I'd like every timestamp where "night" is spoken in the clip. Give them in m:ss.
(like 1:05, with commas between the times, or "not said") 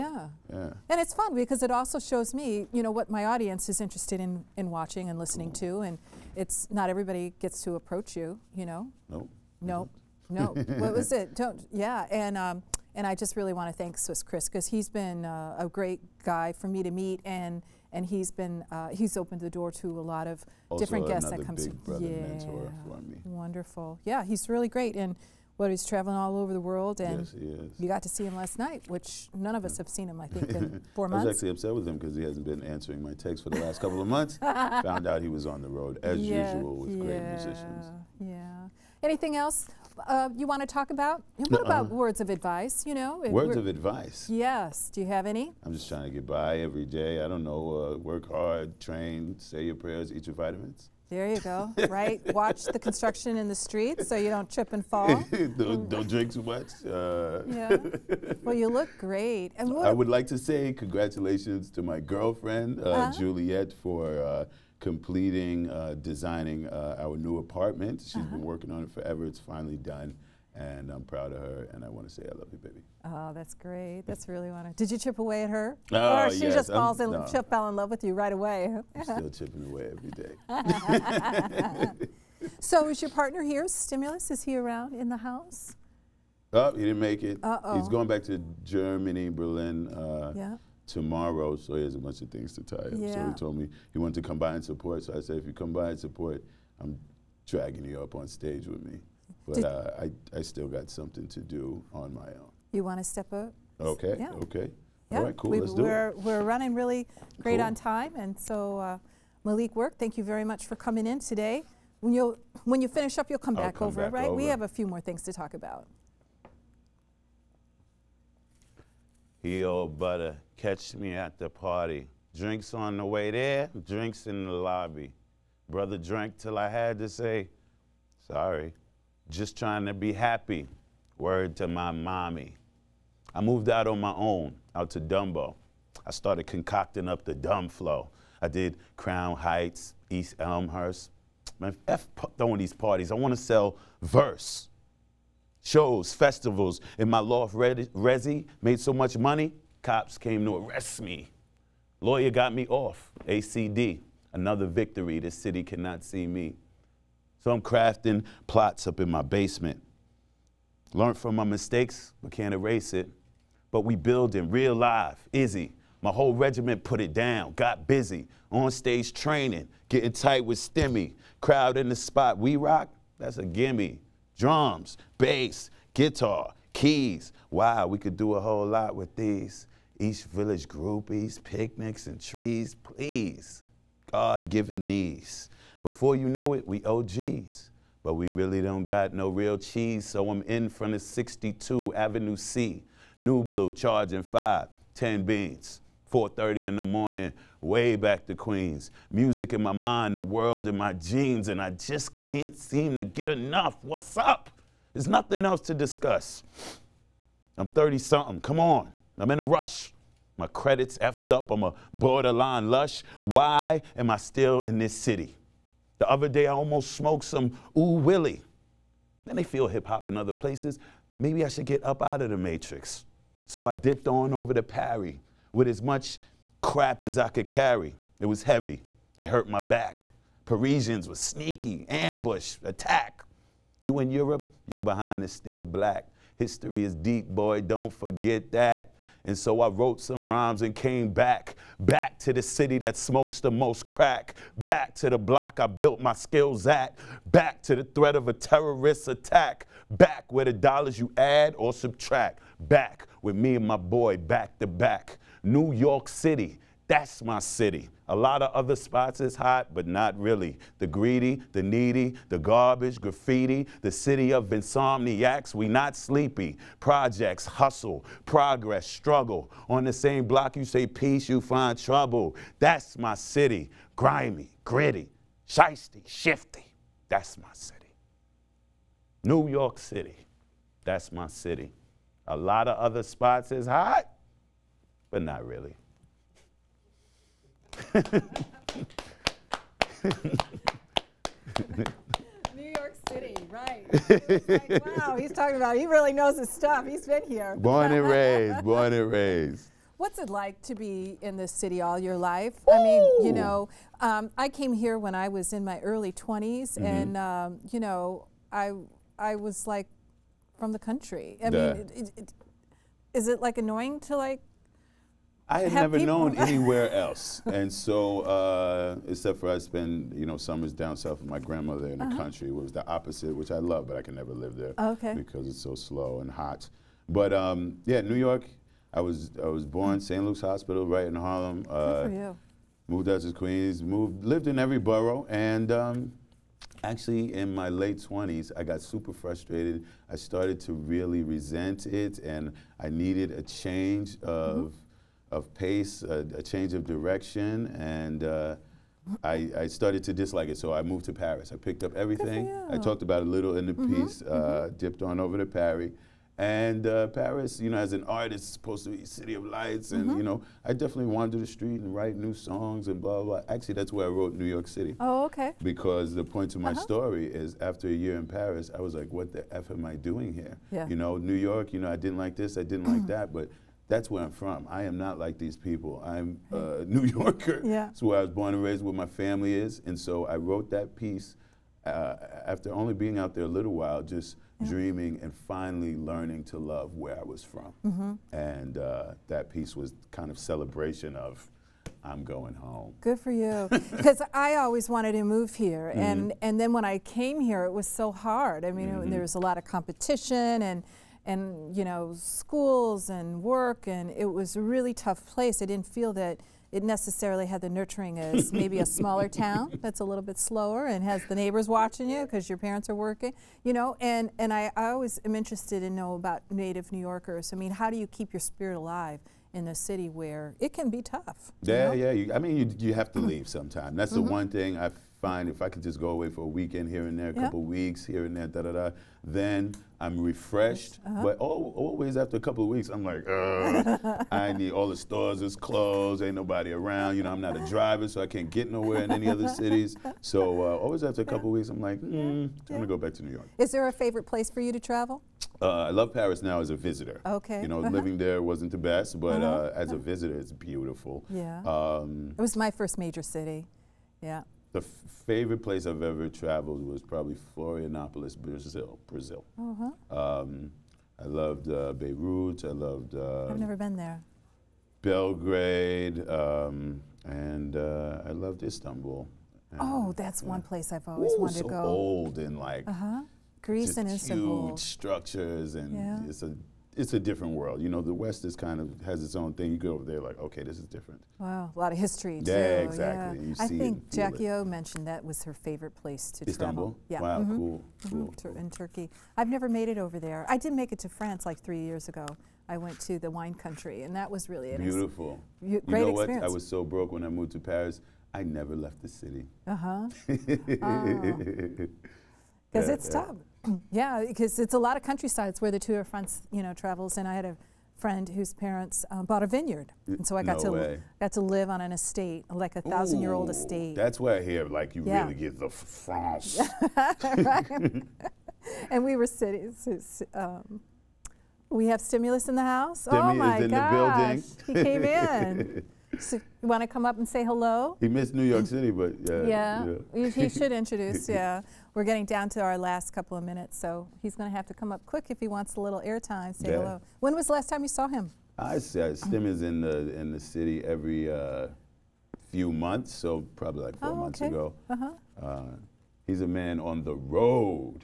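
0:28.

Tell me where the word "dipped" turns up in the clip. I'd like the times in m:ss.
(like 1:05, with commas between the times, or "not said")
3:43, 5:54.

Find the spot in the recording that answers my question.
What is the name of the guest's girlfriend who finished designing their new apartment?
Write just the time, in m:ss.
1:03.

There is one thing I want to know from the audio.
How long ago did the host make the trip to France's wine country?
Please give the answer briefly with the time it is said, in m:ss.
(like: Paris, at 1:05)
3 years, at 8:11.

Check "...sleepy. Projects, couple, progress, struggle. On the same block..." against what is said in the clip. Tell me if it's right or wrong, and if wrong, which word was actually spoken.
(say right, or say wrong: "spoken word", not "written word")
wrong: "hustle", not "couple".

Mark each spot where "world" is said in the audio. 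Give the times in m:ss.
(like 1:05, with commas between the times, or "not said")
0:26, 3:20, 7:57.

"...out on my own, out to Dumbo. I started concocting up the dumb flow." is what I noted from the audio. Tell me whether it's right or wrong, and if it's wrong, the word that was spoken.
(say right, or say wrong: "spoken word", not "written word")
right.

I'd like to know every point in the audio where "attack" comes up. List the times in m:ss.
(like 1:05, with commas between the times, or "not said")
3:52, 4:09.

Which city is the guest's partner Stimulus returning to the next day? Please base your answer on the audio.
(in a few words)
Berlin.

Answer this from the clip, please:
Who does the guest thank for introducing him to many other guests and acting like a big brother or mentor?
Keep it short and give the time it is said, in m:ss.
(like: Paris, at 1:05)
Swiss Chris, at 0:13.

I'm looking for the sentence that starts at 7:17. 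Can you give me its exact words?
You know, I'm not a driver, so I can't get nowhere in any other cities.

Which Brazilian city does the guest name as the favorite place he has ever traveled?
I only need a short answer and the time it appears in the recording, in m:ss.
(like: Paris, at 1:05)
Florianopolis, at 7:37.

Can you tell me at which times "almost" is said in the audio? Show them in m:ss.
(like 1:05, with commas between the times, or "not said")
3:36.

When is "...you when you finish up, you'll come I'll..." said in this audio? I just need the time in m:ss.
1:52.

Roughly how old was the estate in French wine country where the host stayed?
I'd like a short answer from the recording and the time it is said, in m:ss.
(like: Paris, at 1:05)
1000 years, at 8:32.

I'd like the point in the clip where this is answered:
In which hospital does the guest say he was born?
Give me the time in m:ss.
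5:29.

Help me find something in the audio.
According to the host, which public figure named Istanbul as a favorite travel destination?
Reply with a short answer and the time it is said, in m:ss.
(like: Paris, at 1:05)
Jackie O, at 8:04.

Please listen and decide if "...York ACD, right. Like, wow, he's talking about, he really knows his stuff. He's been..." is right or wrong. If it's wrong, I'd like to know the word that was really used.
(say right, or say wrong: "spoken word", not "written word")
wrong: "City", not "ACD".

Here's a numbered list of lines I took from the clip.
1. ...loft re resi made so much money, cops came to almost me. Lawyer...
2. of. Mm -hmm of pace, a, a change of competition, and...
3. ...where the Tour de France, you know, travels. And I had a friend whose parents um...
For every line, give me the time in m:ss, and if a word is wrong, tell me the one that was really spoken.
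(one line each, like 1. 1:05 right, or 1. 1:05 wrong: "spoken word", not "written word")
1. 2:27 wrong: "arrest", not "almost"
2. 5:44 wrong: "direction", not "competition"
3. 8:25 right.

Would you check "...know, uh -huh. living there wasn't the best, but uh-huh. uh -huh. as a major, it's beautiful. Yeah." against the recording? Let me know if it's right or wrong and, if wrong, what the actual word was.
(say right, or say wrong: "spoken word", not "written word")
wrong: "visitor", not "major".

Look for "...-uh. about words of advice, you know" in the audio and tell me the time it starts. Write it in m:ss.
0:41.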